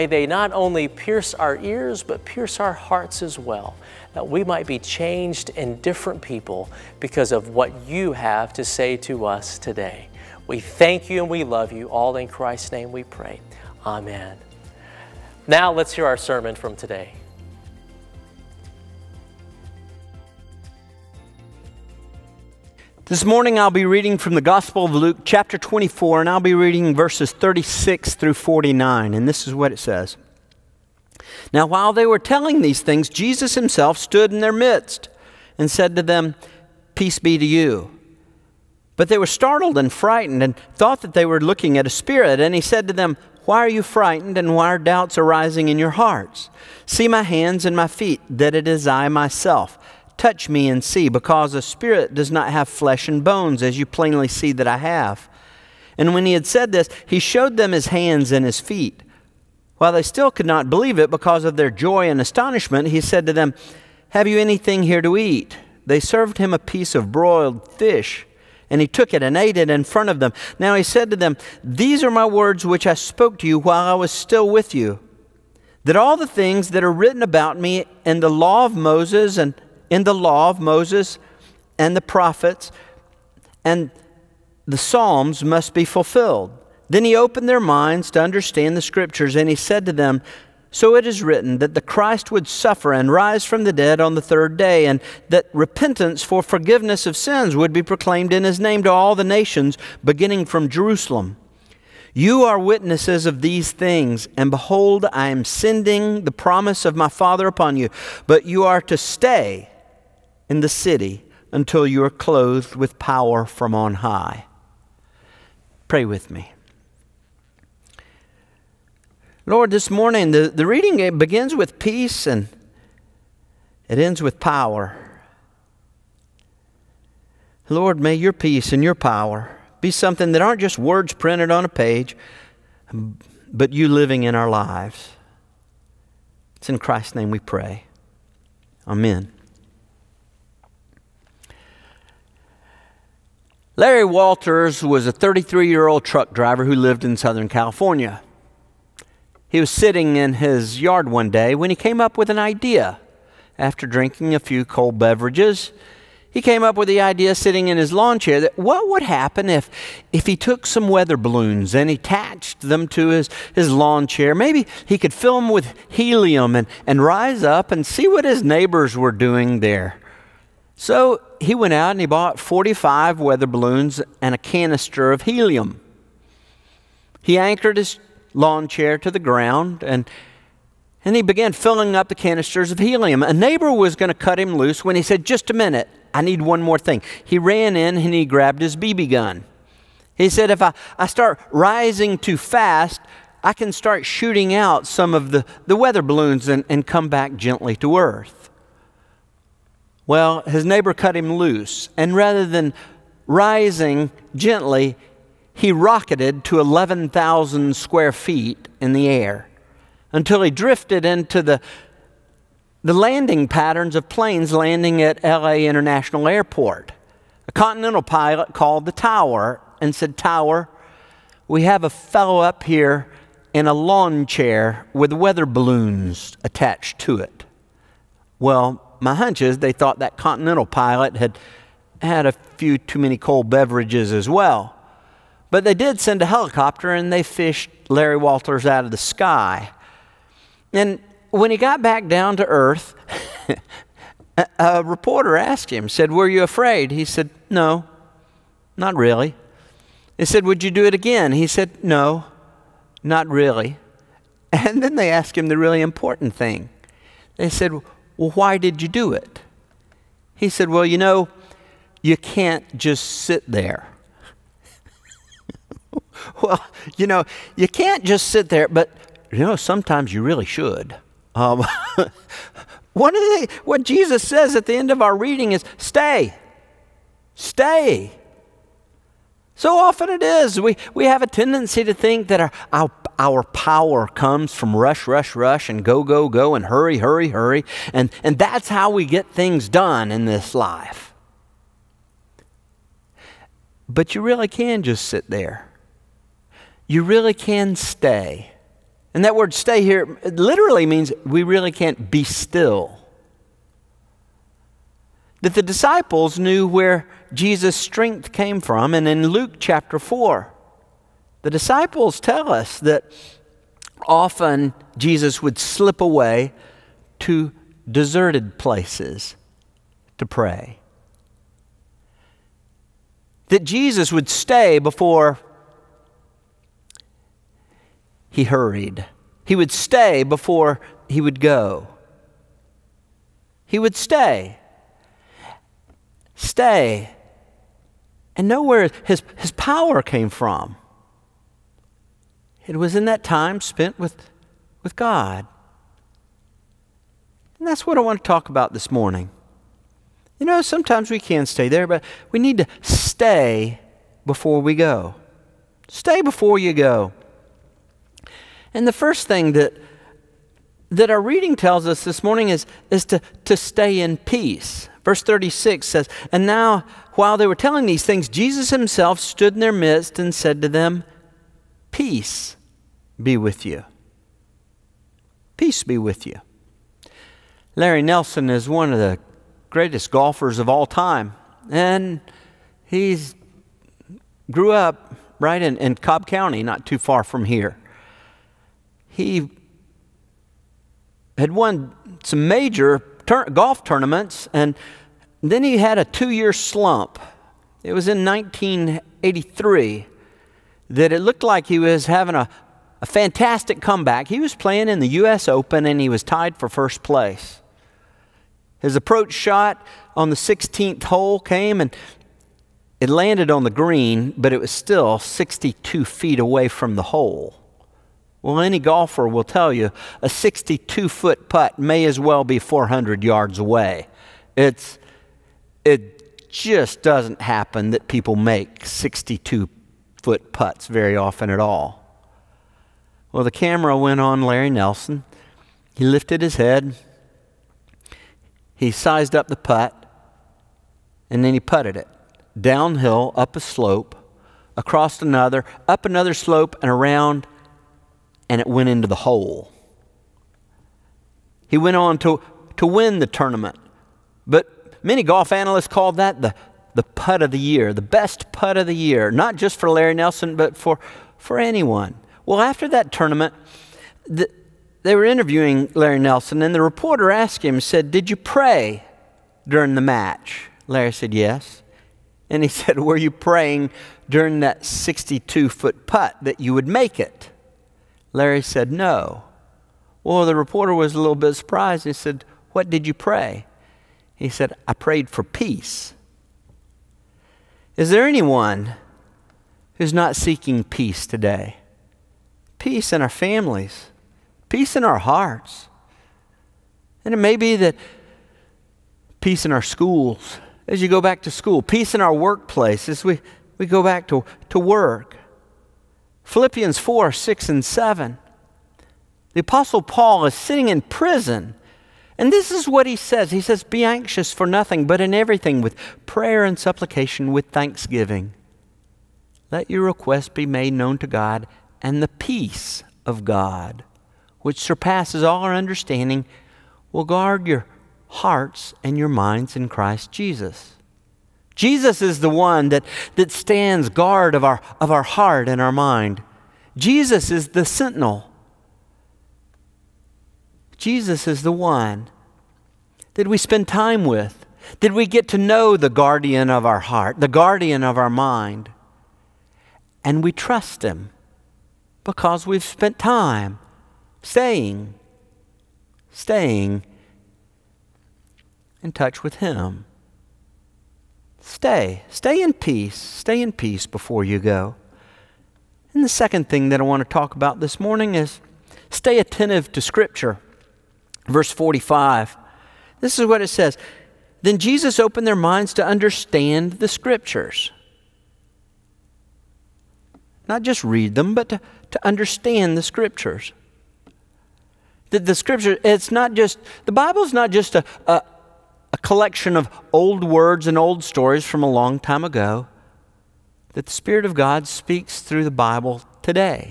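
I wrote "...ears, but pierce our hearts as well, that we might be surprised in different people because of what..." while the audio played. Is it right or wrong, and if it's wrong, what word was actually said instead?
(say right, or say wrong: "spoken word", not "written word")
wrong: "changed", not "surprised".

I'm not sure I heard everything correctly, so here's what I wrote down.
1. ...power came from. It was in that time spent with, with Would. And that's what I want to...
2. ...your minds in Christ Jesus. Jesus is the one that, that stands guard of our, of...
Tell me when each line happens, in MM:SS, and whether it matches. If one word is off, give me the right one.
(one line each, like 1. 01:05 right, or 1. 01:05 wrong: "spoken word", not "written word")
1. 05:39 wrong: "God", not "Would"
2. 08:49 right.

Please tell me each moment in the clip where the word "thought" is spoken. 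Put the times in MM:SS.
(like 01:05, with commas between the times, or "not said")
00:40, 03:49.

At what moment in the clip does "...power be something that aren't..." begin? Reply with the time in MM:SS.
02:08.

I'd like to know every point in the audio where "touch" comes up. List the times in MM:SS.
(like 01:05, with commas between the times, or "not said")
00:50, 09:19.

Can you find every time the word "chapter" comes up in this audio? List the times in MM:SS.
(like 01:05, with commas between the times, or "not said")
00:25, 05:09.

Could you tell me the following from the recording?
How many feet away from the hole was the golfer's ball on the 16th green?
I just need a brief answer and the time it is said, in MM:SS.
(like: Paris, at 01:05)
62, at 06:55.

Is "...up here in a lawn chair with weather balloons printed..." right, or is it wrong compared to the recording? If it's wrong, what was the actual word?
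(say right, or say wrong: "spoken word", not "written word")
wrong: "attached", not "printed".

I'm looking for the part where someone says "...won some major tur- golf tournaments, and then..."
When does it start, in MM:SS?
06:31.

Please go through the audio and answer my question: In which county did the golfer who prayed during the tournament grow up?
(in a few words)
Cobb County.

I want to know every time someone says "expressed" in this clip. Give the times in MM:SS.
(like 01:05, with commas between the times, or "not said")
not said.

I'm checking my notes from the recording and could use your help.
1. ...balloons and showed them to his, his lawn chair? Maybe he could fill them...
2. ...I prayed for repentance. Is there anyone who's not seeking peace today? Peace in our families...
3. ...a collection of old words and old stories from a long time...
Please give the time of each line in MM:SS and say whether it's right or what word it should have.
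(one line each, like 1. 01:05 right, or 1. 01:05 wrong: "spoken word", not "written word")
1. 02:41 wrong: "attached", not "showed"
2. 08:04 wrong: "peace", not "repentance"
3. 09:48 right.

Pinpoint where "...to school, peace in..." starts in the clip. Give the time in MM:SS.
08:21.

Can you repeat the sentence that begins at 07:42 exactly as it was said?
Well, after that tournament, the, they were interviewing Larry Nelson, and the reporter asked him, said, Did you pray during the match?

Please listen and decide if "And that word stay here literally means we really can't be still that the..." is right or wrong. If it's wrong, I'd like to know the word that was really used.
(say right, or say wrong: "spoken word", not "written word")
right.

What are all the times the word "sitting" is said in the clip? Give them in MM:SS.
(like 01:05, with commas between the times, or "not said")
02:29, 02:37, 08:30.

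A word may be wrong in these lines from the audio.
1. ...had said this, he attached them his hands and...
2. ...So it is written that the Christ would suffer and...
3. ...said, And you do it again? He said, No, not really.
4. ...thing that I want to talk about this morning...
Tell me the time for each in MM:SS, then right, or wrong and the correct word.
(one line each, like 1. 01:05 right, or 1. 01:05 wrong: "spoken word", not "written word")
1. 00:56 wrong: "showed", not "attached"
2. 01:30 right
3. 04:10 wrong: "Would", not "And"
4. 09:26 right.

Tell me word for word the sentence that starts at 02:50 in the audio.
So he went out and he bought 45 weather balloons and a canister of helium.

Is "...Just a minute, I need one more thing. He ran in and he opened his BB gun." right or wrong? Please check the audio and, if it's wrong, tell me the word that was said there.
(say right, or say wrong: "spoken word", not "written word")
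wrong: "grabbed", not "opened".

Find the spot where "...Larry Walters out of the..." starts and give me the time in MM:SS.
03:57.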